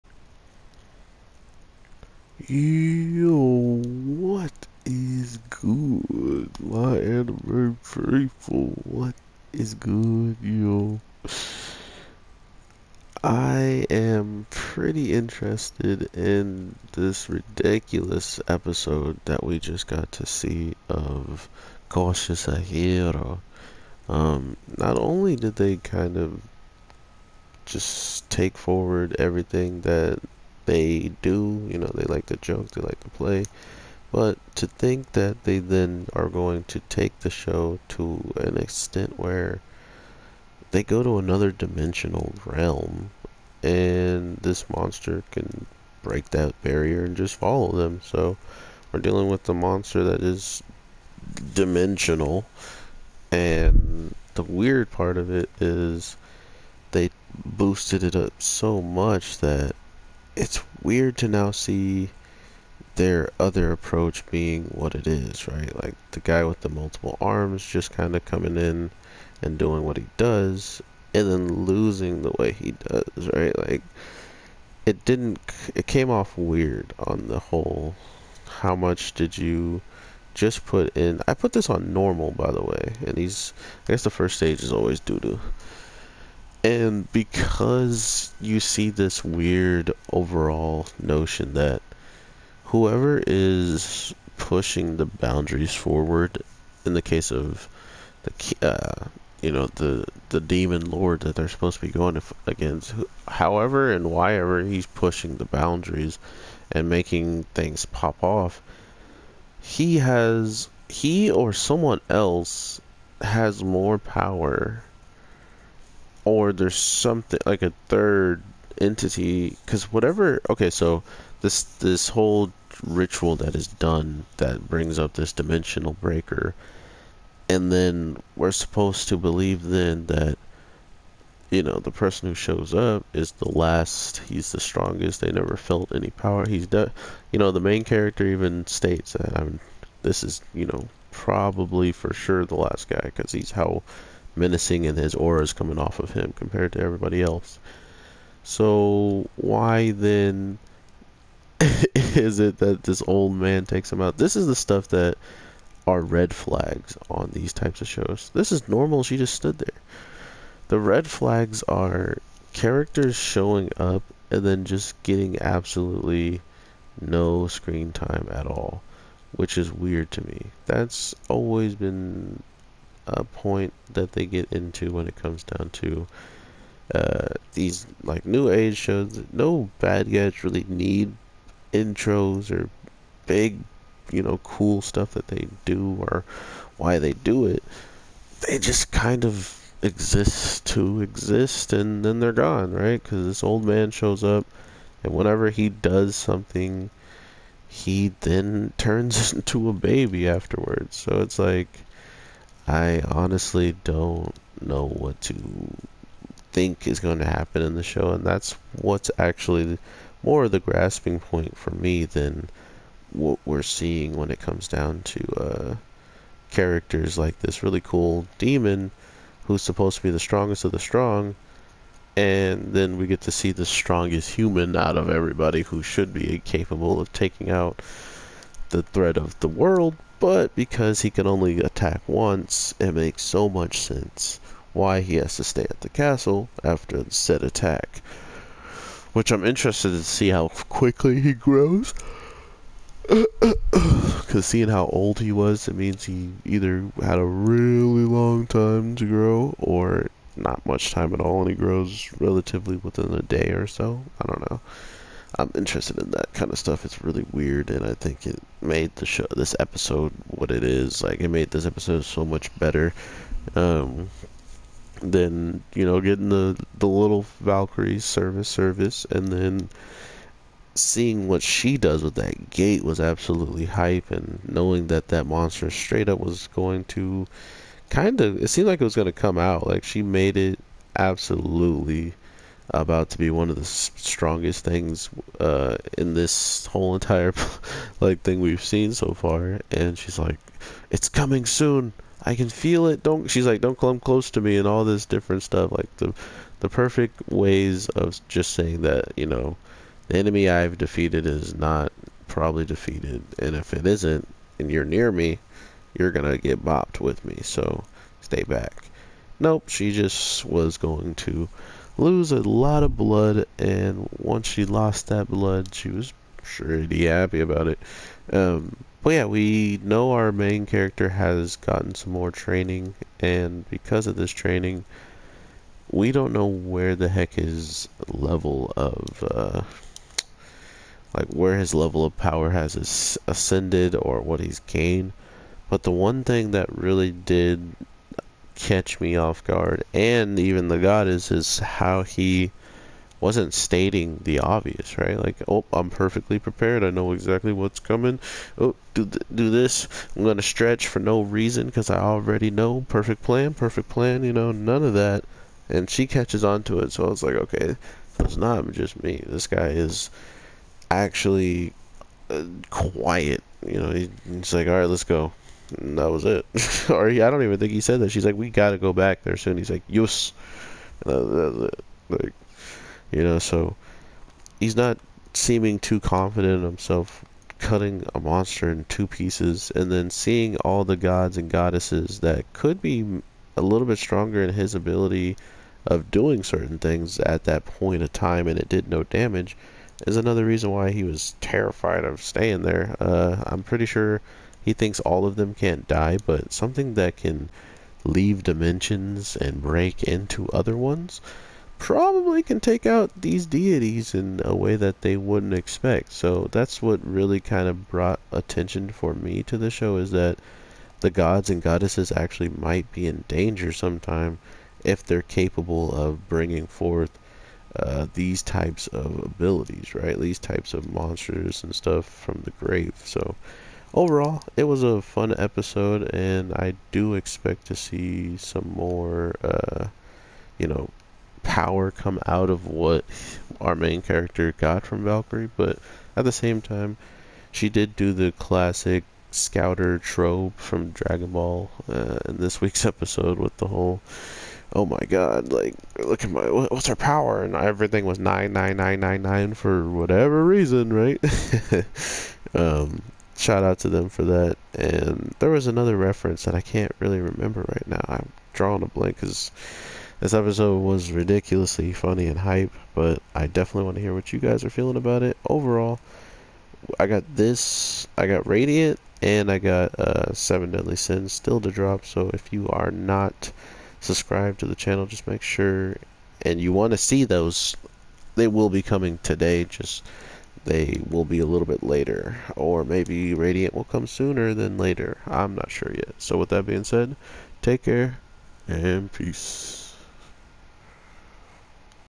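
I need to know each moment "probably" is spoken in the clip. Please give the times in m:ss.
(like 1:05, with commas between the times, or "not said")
2:21, 5:02, 6:41.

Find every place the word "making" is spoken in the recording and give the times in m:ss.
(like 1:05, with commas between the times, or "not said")
1:46.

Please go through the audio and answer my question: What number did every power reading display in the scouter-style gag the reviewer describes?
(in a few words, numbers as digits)
99999.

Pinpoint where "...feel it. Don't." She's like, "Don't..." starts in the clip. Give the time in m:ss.
4:52.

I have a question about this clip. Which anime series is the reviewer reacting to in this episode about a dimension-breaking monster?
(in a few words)
Cautious Hero.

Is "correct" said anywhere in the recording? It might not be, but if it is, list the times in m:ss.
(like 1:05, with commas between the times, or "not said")
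not said.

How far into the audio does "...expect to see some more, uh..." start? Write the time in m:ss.
7:07.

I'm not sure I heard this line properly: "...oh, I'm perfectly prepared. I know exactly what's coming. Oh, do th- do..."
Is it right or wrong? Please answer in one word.
right.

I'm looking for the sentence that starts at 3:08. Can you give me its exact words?
They just kind of exist to exist and then they're gone, right?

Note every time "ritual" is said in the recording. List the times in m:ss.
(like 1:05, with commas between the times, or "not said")
2:02.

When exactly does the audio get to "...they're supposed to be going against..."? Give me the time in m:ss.
1:41.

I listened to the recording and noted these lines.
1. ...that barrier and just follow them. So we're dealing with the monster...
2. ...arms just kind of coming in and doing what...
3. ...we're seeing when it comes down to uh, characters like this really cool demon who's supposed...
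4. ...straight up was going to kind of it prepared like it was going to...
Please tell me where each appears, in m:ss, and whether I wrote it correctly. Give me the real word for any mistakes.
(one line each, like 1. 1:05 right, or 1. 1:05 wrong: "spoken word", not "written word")
1. 0:46 right
2. 1:07 right
3. 3:33 right
4. 4:35 wrong: "seemed", not "prepared".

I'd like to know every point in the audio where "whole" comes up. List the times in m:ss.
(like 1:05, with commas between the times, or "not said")
1:17, 2:02, 4:46, 7:23.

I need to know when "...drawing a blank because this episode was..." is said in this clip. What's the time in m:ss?
7:38.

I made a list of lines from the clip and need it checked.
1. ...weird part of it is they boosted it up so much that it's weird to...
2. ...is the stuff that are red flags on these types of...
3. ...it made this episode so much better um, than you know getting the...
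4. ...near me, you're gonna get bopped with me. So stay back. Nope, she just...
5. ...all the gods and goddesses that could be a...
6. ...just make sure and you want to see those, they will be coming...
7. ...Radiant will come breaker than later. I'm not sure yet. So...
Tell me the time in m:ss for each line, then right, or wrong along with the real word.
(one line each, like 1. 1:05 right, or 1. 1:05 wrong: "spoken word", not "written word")
1. 0:54 right
2. 2:34 right
3. 4:21 right
4. 5:04 right
5. 6:20 right
6. 7:55 right
7. 8:03 wrong: "sooner", not "breaker".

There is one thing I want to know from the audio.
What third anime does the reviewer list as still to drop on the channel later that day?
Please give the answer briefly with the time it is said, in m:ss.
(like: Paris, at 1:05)
Seven Deadly Sins, at 7:50.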